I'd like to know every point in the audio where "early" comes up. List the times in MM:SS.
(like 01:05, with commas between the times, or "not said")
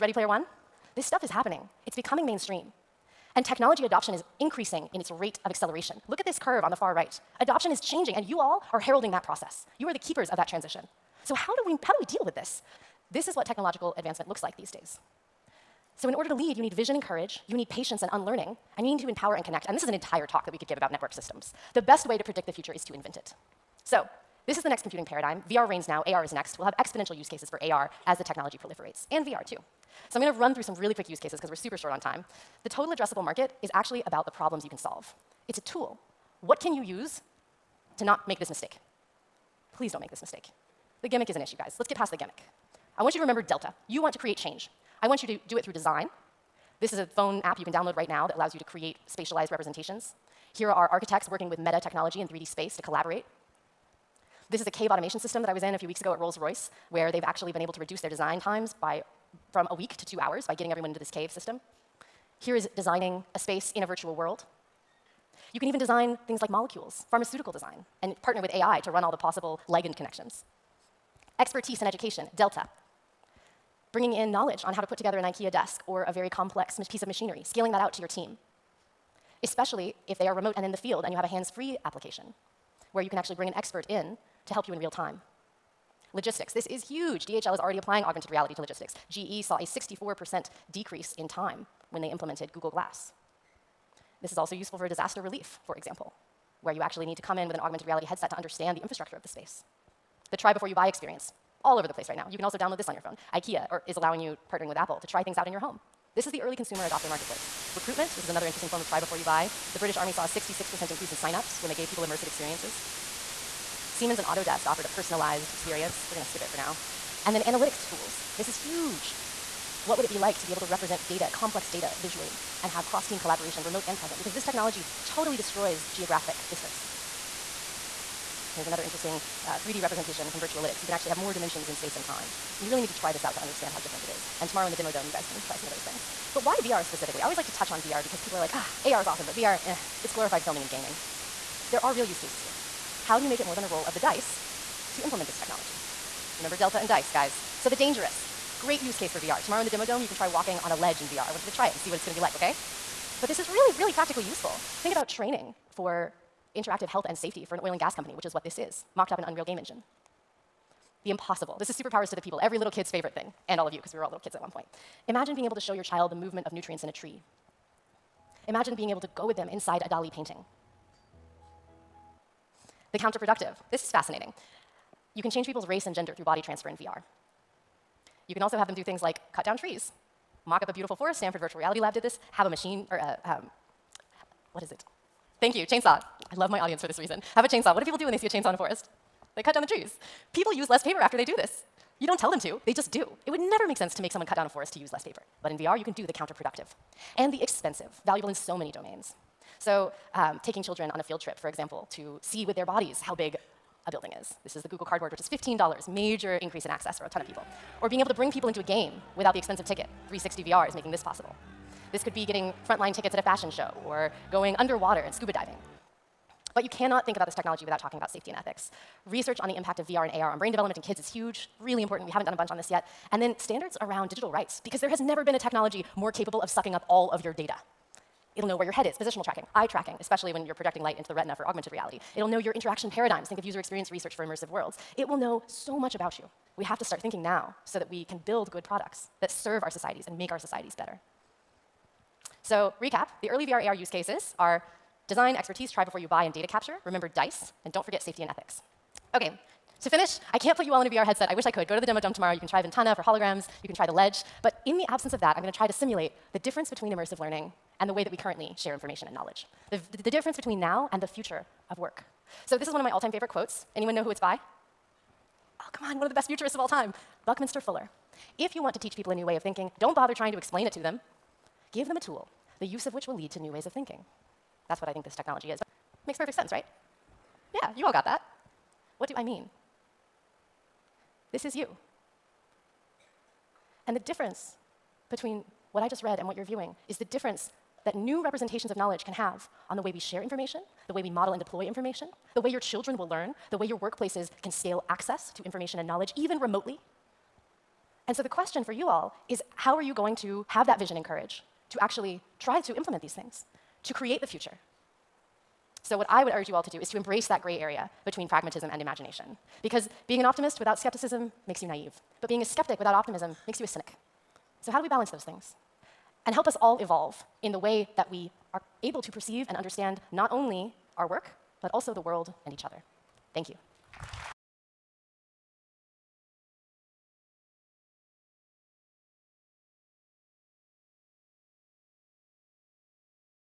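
01:46, 04:03.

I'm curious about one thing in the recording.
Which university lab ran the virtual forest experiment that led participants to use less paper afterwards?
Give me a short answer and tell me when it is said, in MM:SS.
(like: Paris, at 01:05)
Stanford Virtual Reality Lab, at 03:01.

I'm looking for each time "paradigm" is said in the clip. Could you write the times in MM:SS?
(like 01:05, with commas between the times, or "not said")
00:25, 03:52.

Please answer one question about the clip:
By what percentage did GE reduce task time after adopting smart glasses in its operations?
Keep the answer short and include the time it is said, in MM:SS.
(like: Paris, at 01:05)
64%, at 01:29.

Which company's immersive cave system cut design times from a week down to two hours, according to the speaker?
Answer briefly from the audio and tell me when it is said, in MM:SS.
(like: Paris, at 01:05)
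Rolls-Royce, at 00:56.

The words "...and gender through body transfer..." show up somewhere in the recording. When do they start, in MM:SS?
02:55.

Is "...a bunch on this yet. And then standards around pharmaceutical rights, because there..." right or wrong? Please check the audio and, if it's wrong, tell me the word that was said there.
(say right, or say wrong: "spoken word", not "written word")
wrong: "digital", not "pharmaceutical".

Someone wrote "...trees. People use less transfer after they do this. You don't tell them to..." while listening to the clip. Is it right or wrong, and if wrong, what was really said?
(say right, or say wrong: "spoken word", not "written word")
wrong: "paper", not "transfer".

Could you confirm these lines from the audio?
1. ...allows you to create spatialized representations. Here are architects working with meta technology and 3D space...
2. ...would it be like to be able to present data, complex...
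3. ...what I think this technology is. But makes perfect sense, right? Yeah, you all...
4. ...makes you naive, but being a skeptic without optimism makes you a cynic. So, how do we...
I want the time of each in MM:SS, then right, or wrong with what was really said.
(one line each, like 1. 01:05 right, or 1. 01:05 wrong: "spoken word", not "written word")
1. 00:48 right
2. 01:59 wrong: "represent", not "present"
3. 04:34 right
4. 05:11 right.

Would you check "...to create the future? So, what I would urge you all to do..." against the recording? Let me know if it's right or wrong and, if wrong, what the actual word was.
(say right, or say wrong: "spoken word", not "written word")
right.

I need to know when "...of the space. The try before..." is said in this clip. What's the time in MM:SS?
01:39.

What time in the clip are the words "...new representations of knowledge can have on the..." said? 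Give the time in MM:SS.
04:47.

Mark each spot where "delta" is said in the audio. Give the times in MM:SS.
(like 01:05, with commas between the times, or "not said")
00:43, 01:12, 02:26.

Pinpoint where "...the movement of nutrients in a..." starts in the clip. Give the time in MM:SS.
02:46.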